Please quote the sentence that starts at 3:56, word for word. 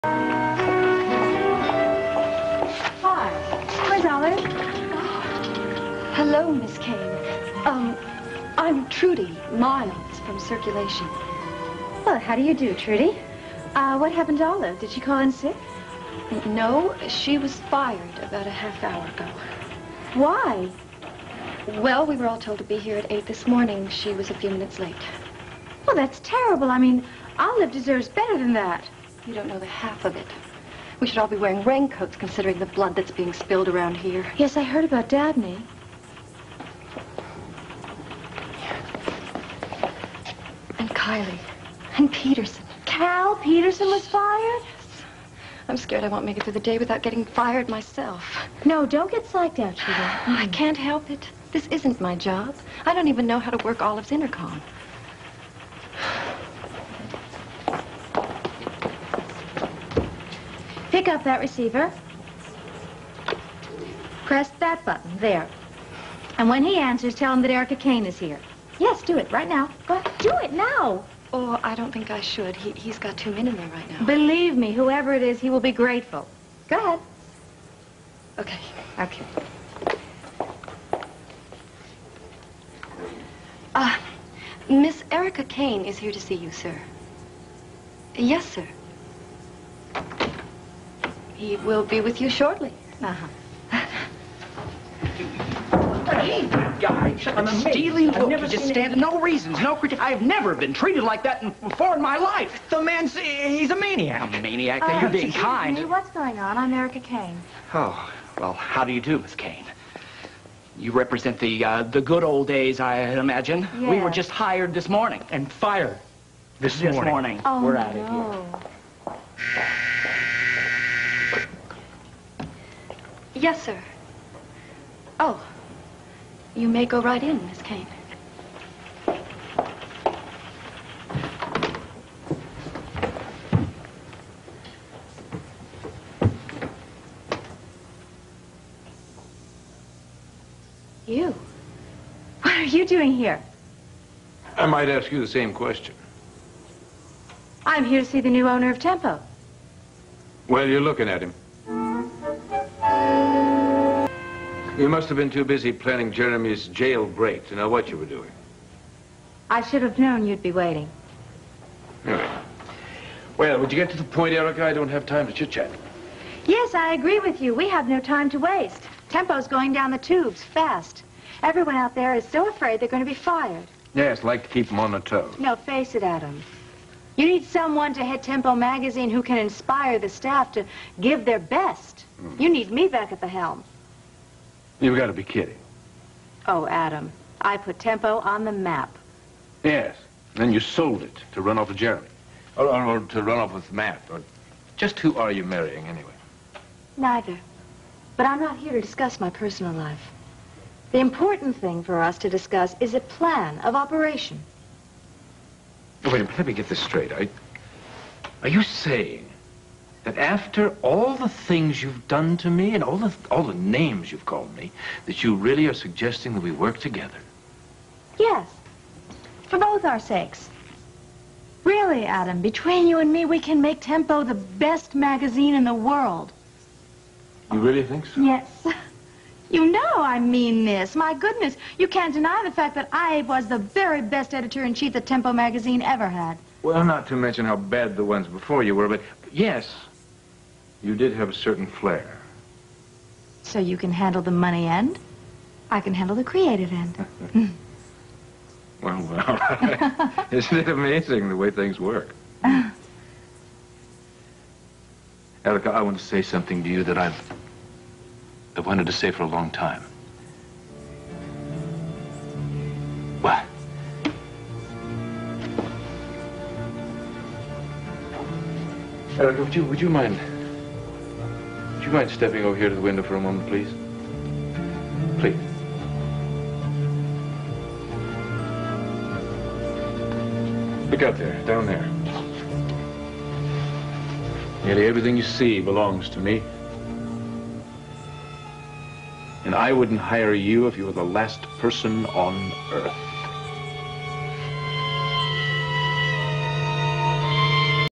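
Well, not to mention how bad the ones before you were, but yes, you did have a certain flair.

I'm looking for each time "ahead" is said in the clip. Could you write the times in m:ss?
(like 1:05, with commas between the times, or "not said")
1:09, 1:16.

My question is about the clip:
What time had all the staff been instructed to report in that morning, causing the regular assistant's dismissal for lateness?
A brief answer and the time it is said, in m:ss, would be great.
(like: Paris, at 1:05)
8, at 0:23.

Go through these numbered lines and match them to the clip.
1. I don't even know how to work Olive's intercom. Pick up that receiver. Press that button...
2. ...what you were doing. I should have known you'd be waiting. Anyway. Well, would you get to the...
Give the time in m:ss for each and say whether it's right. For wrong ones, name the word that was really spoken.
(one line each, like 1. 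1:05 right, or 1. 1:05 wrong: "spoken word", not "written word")
1. 0:52 right
2. 2:37 right.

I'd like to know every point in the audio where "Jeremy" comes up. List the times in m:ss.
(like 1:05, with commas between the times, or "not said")
2:36, 3:11.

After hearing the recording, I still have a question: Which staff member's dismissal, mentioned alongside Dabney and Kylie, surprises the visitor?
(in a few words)
Cal Peterson.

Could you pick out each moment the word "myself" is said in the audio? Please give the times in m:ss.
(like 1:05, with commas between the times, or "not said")
0:47.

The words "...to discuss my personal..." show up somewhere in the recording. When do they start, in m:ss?
3:18.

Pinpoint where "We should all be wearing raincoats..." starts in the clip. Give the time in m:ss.
0:30.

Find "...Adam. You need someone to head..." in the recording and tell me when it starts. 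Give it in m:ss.
2:56.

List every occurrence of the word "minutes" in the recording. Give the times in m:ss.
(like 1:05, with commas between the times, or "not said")
0:24, 3:26.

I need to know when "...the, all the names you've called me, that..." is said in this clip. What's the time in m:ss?
3:32.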